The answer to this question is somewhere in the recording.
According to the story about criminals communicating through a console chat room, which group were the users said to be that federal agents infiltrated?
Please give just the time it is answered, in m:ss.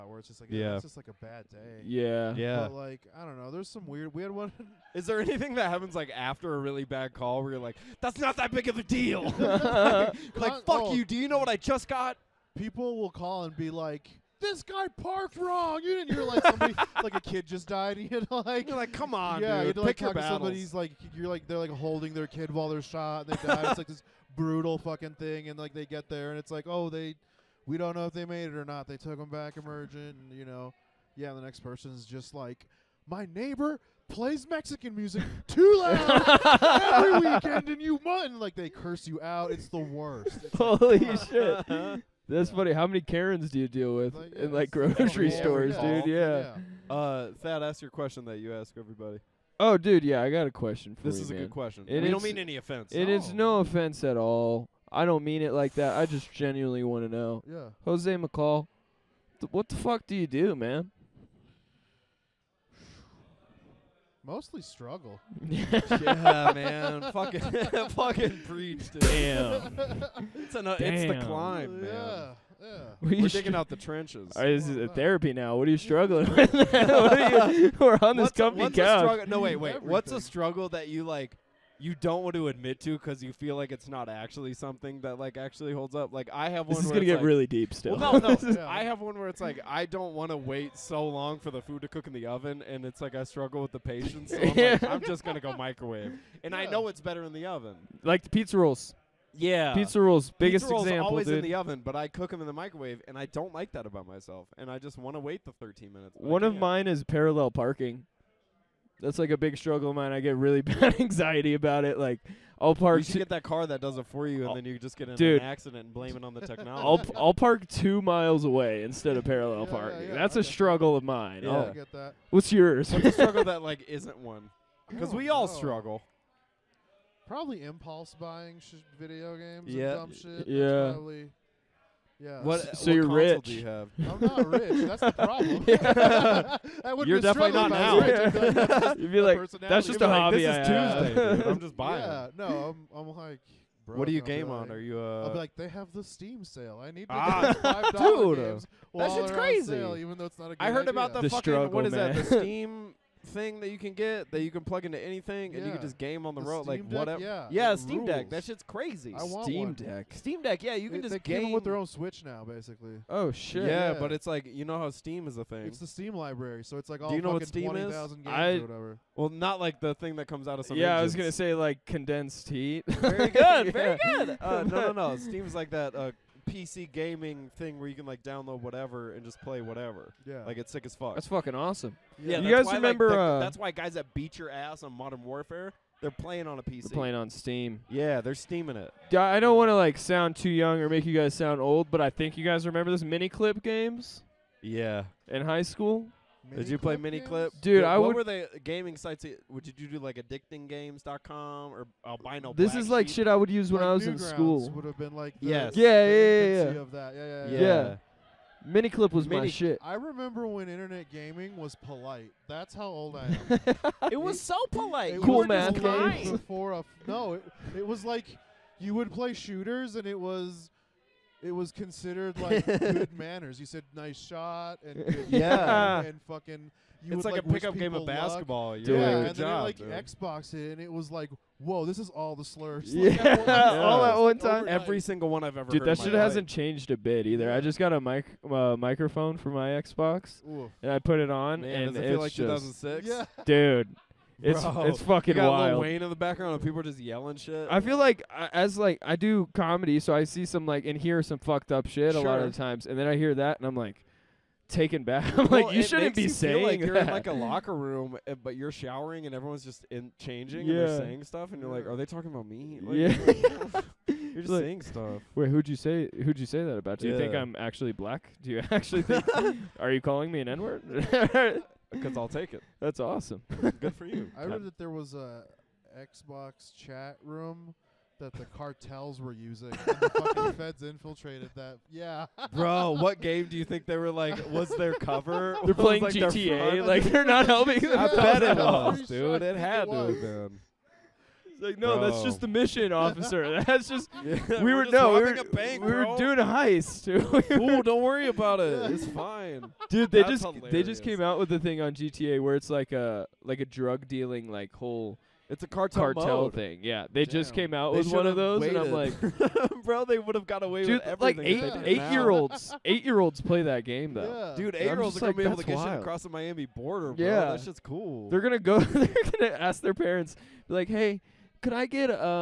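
4:38.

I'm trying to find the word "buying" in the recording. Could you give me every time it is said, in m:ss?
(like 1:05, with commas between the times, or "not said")
2:08, 2:21.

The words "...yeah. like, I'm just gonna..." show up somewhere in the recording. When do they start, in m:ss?
1:34.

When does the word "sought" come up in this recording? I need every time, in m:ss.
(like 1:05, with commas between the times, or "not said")
not said.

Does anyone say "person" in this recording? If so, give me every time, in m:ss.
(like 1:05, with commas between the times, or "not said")
0:31.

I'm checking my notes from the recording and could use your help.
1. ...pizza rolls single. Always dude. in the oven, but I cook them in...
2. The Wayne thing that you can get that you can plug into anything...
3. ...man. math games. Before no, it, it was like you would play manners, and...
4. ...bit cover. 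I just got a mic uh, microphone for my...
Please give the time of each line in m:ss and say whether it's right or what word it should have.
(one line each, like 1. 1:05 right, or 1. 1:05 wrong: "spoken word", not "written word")
1. 1:40 wrong: "example", not "single"
2. 2:32 wrong: "Steam", not "Wayne"
3. 3:35 wrong: "shooters", not "manners"
4. 3:56 wrong: "either", not "cover".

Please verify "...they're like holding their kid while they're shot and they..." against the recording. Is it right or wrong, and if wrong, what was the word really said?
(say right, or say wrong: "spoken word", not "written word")
right.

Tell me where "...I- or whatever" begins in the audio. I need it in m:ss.
2:48.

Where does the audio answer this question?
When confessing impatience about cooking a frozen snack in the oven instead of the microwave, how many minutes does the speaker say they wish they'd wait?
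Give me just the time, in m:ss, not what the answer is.
1:45.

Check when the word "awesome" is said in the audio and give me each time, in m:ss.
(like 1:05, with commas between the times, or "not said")
3:01, 4:32.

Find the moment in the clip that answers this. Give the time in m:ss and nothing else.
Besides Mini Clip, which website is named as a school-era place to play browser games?
3:20.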